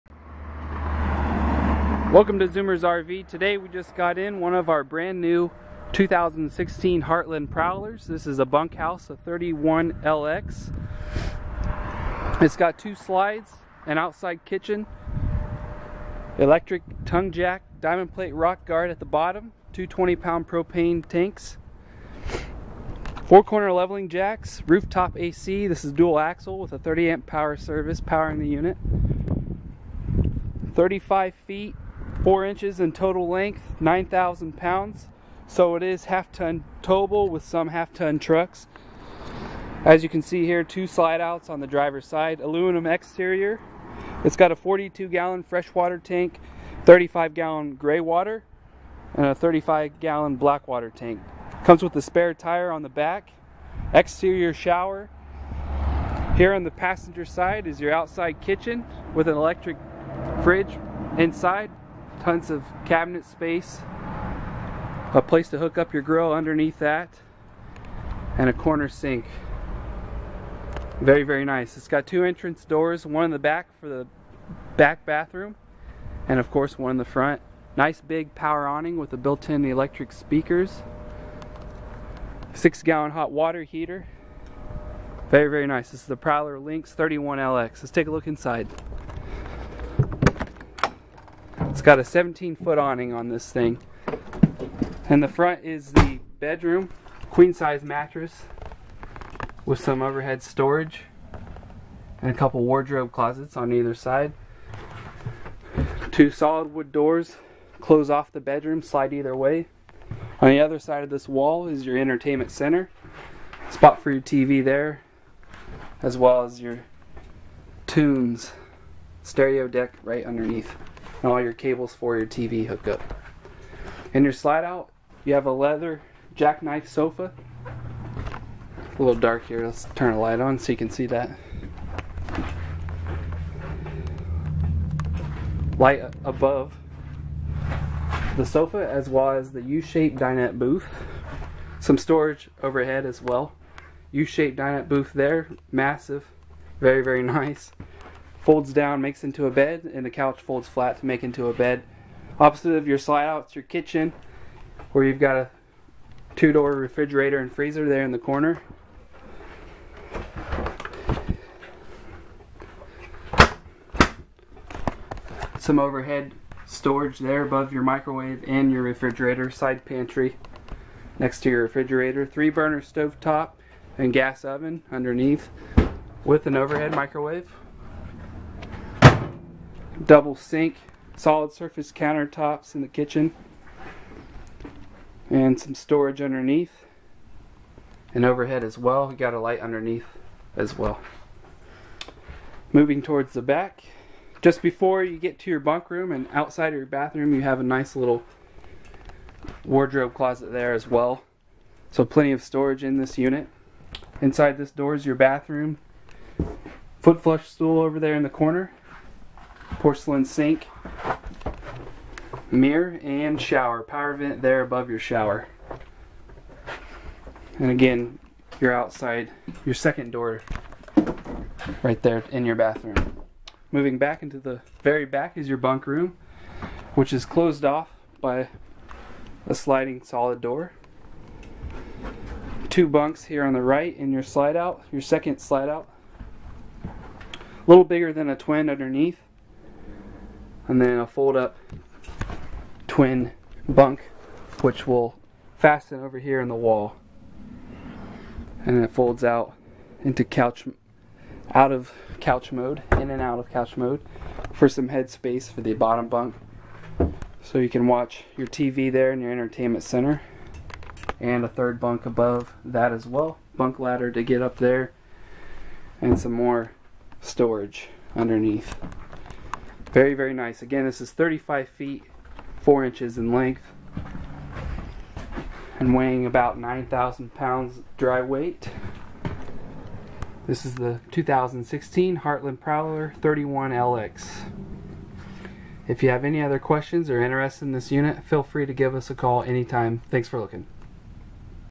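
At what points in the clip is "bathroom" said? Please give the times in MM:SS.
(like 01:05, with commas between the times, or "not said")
01:15, 03:16, 03:25, 03:42.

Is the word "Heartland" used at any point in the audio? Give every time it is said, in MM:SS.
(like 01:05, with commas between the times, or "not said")
00:07, 04:42.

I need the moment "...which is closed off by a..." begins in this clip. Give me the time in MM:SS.
03:46.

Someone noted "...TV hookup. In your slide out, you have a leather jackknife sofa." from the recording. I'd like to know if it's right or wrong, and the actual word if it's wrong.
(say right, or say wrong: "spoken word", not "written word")
right.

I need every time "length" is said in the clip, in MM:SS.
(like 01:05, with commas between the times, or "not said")
00:33, 04:33.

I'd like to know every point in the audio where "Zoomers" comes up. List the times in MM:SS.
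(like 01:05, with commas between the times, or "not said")
00:02.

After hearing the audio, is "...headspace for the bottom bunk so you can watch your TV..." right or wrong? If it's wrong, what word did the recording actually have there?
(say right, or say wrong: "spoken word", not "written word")
right.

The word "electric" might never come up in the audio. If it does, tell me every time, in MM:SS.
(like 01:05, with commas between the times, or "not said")
00:16, 00:59, 01:19.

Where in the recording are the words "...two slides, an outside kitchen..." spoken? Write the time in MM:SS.
00:12.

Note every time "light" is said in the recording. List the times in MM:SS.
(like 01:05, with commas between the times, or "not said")
02:10, 02:15, 03:09.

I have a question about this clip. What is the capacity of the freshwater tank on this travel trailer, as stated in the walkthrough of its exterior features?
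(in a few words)
42 gallons.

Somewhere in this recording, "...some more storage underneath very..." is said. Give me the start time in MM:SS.
04:26.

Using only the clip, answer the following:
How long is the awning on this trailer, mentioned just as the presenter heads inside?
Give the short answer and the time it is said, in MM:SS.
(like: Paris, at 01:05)
17 feet, at 01:32.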